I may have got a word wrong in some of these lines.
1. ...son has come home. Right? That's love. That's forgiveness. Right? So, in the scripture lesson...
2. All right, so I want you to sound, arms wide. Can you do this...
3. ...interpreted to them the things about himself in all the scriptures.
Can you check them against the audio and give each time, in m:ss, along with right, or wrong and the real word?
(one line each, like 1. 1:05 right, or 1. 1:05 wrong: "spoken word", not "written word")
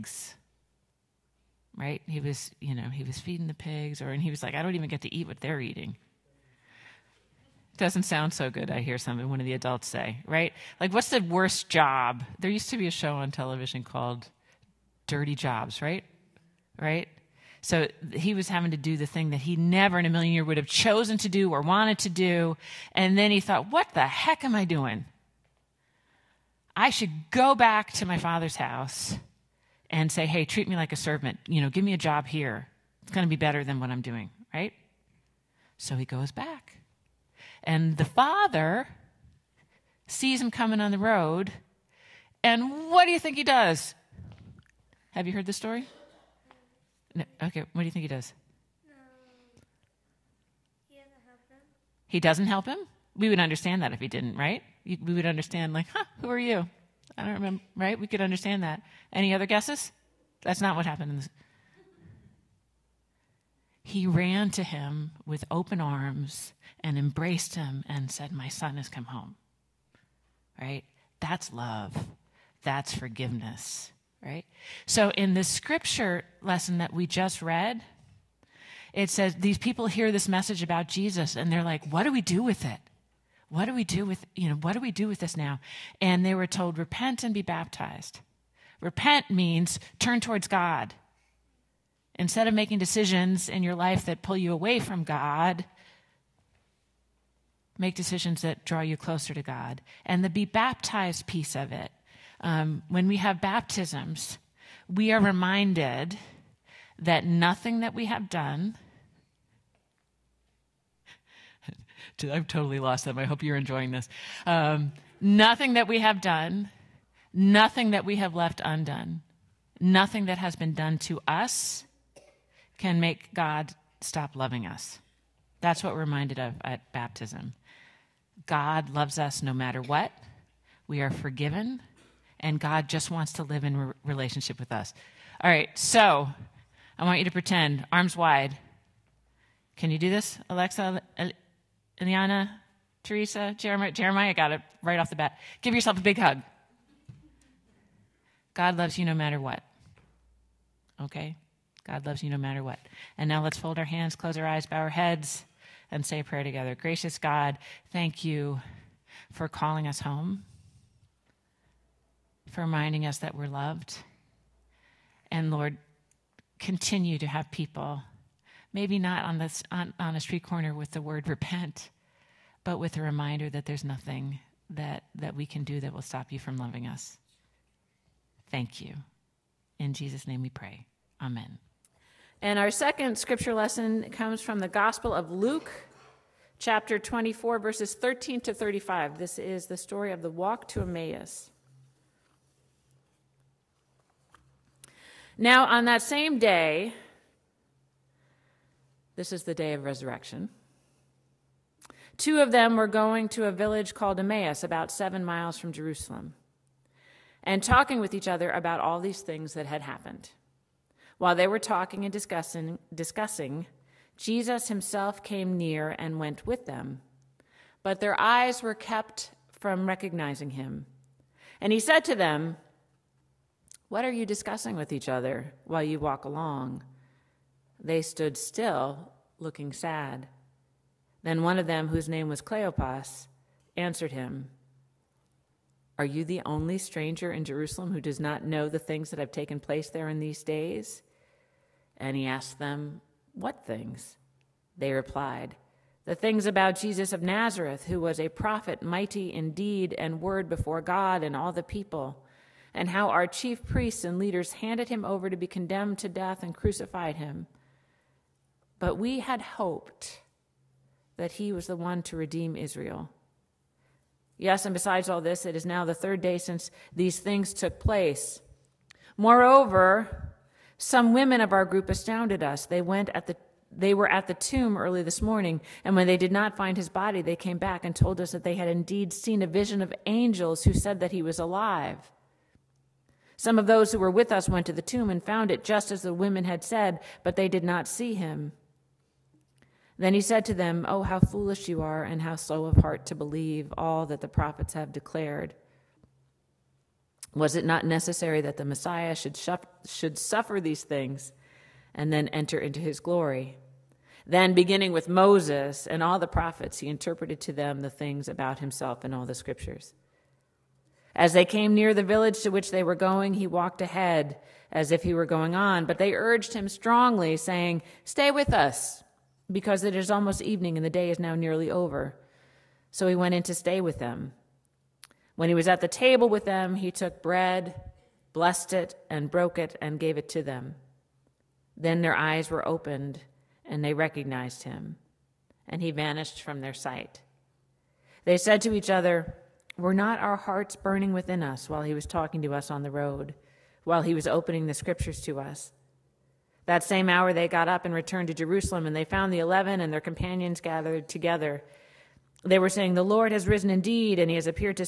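1. 1:08 right
2. 2:15 wrong: "pretend", not "sound"
3. 5:06 right.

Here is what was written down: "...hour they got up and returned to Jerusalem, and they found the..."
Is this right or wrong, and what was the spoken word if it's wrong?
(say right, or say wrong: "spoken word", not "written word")
right.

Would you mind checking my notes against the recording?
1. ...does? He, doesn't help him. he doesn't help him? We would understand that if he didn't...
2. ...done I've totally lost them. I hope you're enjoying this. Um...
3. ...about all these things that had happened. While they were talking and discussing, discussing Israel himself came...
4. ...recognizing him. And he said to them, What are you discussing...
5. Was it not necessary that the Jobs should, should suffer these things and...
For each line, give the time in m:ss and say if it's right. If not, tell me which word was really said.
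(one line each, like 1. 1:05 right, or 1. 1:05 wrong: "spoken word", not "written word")
1. 0:48 right
2. 1:48 right
3. 3:28 wrong: "Jesus", not "Israel"
4. 3:39 right
5. 4:57 wrong: "Messiah", not "Jobs".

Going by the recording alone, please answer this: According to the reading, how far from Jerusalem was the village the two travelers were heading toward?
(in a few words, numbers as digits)
7 miles.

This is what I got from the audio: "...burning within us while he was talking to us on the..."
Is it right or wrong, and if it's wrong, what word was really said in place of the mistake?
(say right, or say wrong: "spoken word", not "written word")
right.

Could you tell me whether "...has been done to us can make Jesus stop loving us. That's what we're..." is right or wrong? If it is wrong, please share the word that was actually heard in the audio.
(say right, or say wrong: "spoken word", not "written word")
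wrong: "God", not "Jesus".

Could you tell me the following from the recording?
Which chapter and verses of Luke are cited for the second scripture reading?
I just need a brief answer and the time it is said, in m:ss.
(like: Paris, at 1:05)
Chapter 24, verses 13 to 35, at 3:06.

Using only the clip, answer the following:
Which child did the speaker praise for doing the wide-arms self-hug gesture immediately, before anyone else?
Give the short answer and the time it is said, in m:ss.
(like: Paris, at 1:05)
Jeremiah, at 2:23.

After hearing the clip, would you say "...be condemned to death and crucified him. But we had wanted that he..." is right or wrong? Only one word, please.
wrong.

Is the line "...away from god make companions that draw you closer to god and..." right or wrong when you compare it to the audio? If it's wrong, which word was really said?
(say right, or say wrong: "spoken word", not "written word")
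wrong: "decisions", not "companions".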